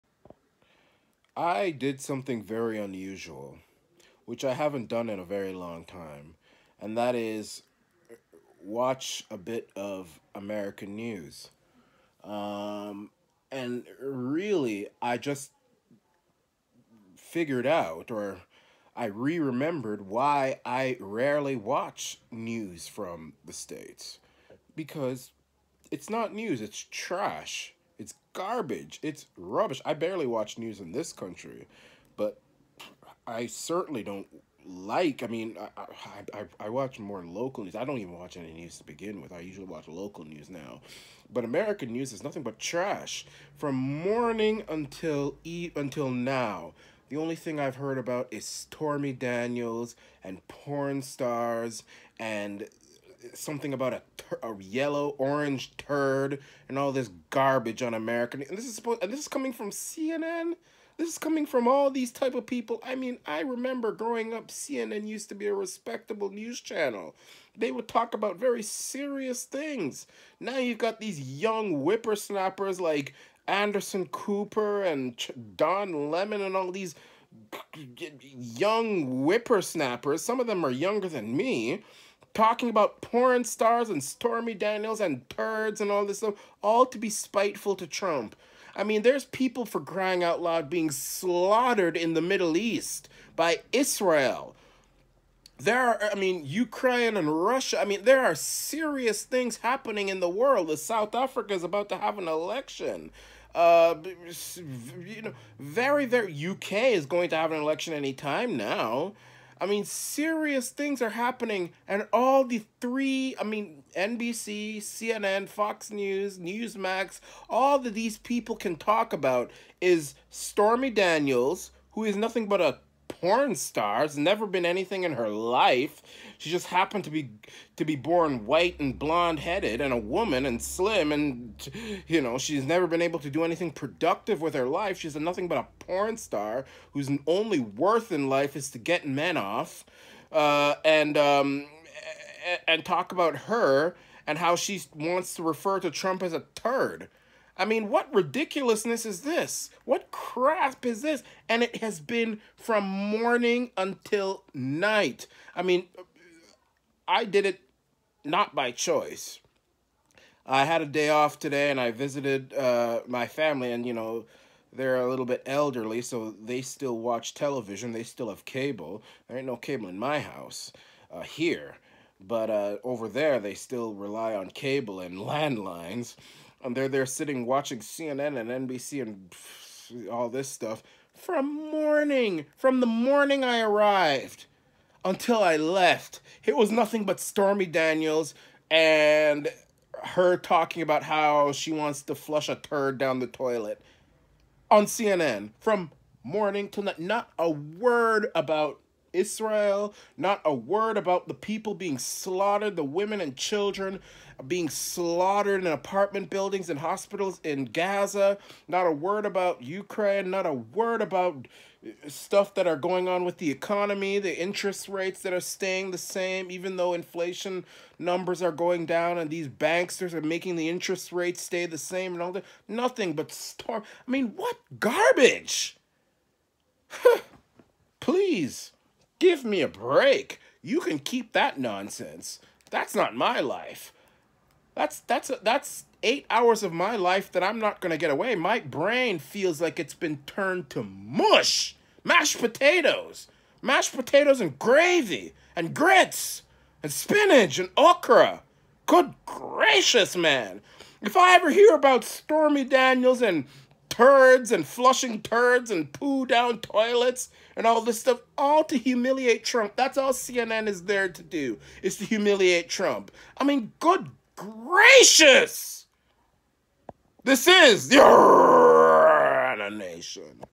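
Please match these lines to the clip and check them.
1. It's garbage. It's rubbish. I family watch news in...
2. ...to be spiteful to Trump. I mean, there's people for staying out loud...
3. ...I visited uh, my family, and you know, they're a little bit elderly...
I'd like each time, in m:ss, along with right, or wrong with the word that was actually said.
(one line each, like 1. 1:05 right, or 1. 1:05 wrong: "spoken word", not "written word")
1. 0:28 wrong: "barely", not "family"
2. 1:26 wrong: "crying", not "staying"
3. 2:41 right.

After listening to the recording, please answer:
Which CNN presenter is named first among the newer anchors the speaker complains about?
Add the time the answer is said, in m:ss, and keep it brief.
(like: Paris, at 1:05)
Anderson Cooper, at 1:13.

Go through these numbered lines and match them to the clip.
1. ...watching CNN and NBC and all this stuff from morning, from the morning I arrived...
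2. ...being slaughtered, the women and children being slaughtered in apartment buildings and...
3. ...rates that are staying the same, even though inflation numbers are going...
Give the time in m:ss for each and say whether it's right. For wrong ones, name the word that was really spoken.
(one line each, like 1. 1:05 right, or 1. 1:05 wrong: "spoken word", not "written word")
1. 2:57 right
2. 3:21 right
3. 3:34 right.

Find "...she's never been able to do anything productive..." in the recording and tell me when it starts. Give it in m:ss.
2:12.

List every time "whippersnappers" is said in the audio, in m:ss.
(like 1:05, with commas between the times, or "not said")
1:11, 1:19.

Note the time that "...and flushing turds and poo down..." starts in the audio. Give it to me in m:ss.
4:14.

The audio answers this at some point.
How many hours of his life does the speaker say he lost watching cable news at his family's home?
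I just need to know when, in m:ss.
3:56.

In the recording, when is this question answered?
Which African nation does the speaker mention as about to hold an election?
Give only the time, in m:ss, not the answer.
1:40.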